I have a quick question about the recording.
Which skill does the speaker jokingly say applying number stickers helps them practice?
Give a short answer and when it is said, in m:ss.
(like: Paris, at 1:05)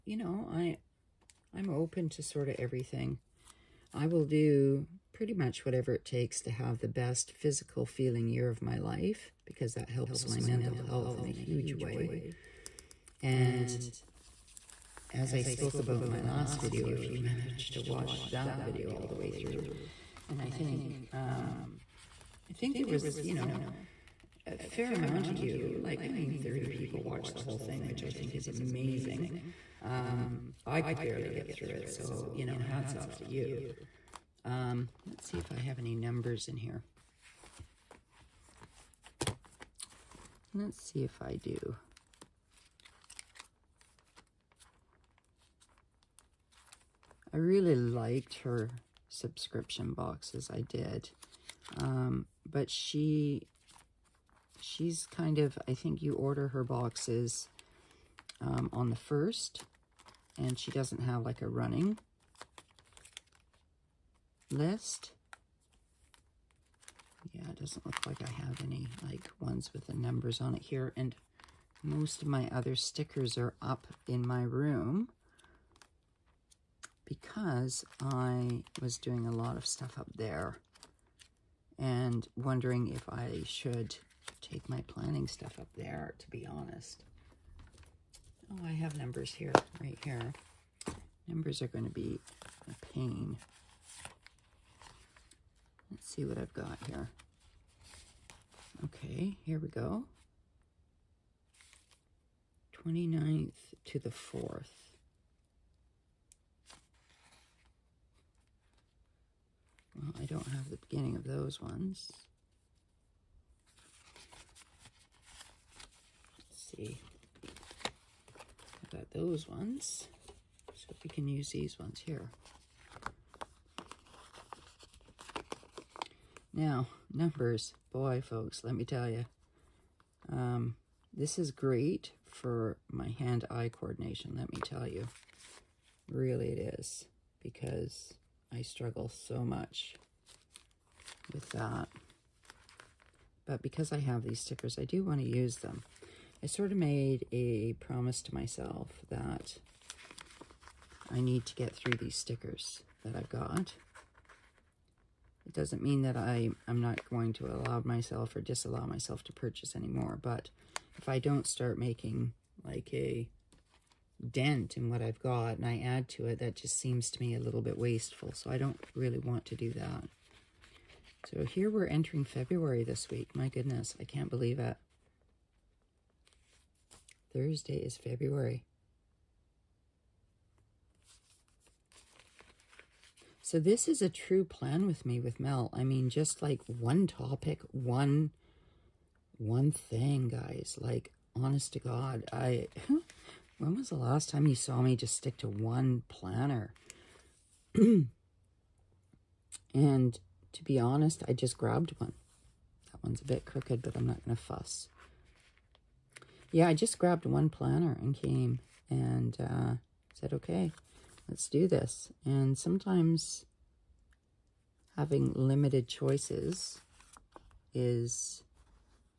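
hand-eye coordination, at 2:13.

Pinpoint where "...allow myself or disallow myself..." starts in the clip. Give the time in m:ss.
2:37.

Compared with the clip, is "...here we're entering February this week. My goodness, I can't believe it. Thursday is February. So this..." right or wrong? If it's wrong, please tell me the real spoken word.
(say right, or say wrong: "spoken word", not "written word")
right.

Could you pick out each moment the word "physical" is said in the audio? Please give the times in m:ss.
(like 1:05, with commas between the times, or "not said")
0:07.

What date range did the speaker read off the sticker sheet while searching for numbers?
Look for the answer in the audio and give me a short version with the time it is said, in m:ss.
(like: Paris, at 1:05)
29th to the 4th, at 1:42.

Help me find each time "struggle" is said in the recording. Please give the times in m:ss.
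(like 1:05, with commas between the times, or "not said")
2:18.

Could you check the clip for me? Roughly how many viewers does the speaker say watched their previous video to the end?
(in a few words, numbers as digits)
30.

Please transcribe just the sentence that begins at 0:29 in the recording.
Um, I could barely get through it, so, you know, hats off to you.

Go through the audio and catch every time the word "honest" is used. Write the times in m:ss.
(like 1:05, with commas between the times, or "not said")
1:26, 3:11, 3:20.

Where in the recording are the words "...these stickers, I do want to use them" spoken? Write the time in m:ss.
2:24.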